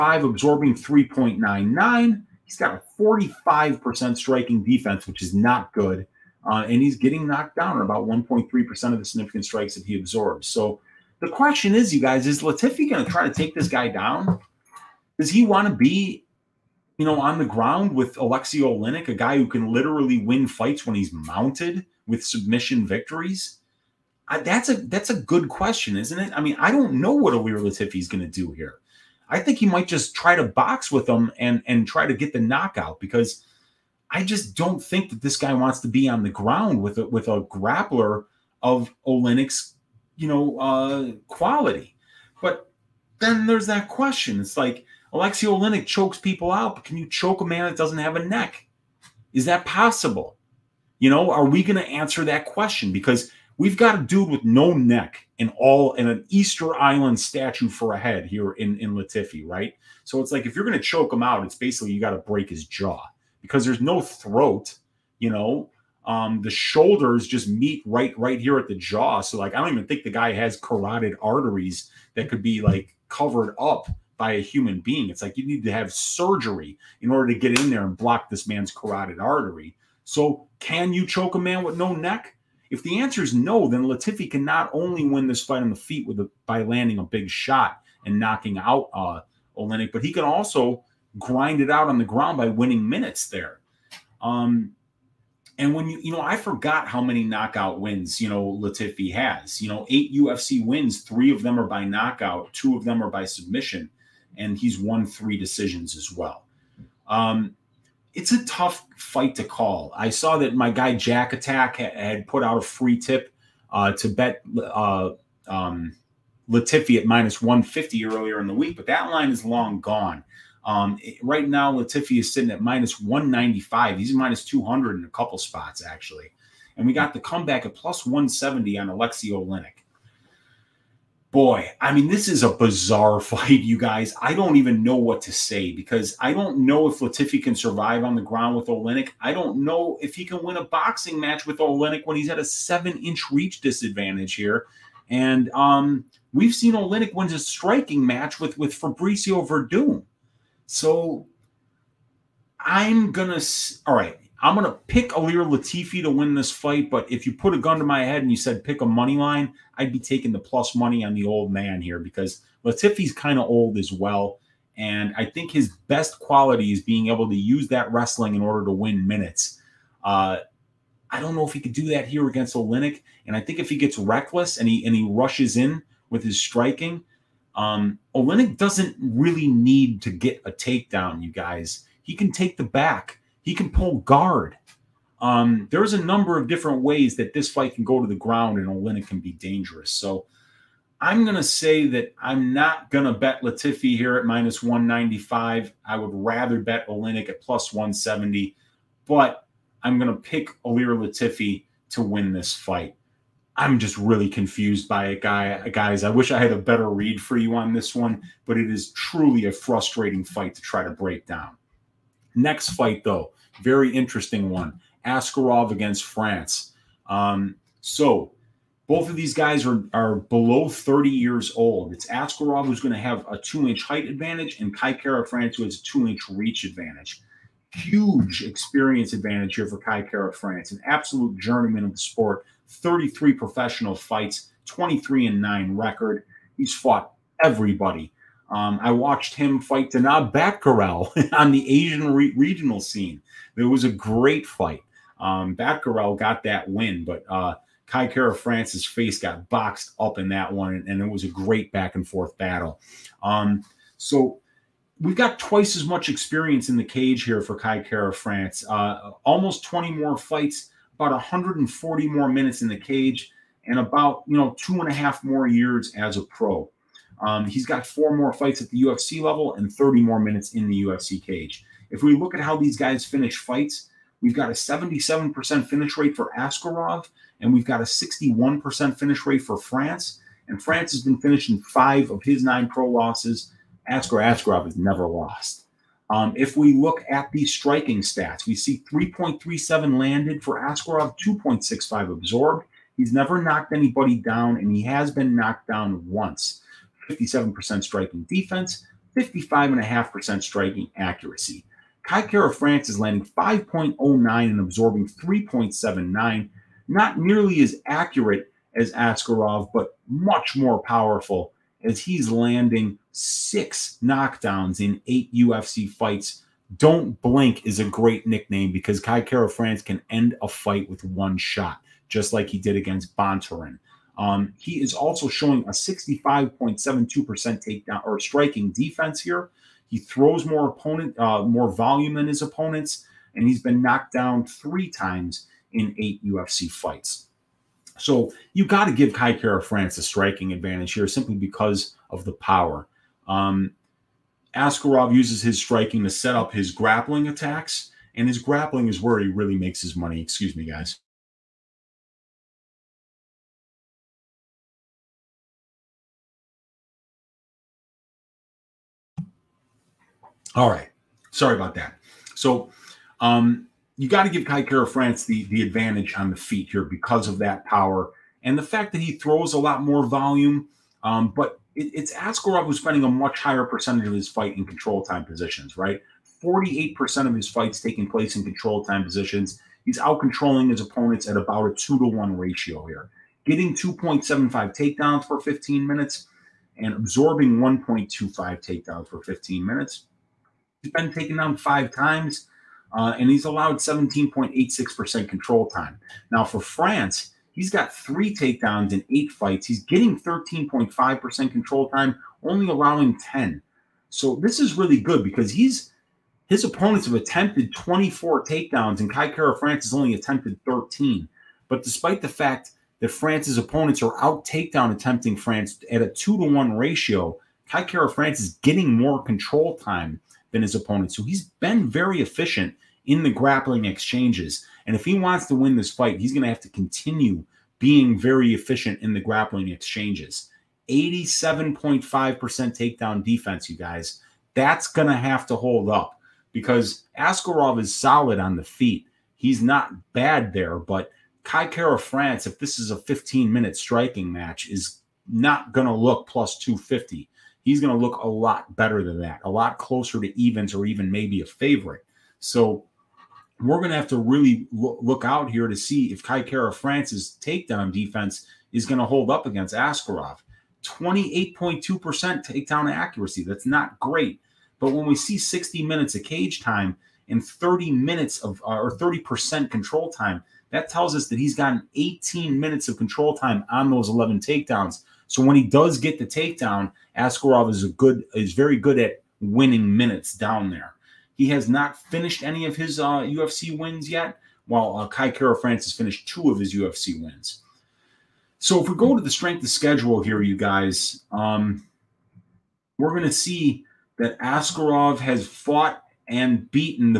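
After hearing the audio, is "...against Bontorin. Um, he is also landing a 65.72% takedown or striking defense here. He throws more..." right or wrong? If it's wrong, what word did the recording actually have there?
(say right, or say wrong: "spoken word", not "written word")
wrong: "showing", not "landing".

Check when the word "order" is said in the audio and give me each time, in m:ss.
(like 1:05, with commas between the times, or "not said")
1:17, 2:48.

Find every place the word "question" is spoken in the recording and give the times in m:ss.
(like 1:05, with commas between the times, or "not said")
0:11, 0:25, 0:43, 0:52.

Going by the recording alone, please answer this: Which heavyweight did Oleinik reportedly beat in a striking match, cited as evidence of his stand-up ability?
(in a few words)
Fabricio Werdum.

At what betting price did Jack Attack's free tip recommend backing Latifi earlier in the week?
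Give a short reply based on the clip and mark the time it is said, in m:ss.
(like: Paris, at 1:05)
-150, at 1:57.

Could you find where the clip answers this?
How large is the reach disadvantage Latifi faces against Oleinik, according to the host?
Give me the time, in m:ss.
2:22.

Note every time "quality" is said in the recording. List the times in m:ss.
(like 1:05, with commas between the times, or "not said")
0:41, 2:46.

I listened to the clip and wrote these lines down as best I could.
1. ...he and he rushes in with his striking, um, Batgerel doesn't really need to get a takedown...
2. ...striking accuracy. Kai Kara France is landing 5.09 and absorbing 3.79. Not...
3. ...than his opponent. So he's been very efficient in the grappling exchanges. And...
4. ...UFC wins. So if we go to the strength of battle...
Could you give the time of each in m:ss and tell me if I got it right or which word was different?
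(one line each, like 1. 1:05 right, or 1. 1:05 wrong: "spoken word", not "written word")
1. 2:54 wrong: "Oleinik", not "Batgerel"
2. 5:00 right
3. 7:00 right
4. 8:06 wrong: "schedule", not "battle".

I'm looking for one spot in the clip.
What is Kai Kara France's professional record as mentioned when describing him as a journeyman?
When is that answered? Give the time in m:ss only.
3:54.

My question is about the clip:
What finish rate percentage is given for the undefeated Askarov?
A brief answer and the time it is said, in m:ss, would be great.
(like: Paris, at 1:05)
77%, at 4:34.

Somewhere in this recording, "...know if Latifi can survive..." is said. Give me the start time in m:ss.
2:16.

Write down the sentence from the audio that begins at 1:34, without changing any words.
Um, and when you, you know, I forgot how many knockout wins, you know, Latifi has.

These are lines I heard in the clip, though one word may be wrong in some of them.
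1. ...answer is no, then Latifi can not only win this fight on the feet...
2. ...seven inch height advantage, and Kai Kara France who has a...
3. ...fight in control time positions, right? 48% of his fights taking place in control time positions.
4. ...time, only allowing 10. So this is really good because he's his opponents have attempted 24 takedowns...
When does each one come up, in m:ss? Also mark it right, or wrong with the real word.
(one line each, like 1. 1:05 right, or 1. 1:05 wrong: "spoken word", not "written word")
1. 1:22 right
2. 3:43 wrong: "two", not "seven"
3. 6:14 right
4. 6:41 right.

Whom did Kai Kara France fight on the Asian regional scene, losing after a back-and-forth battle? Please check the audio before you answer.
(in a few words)
Danaa Batgerel.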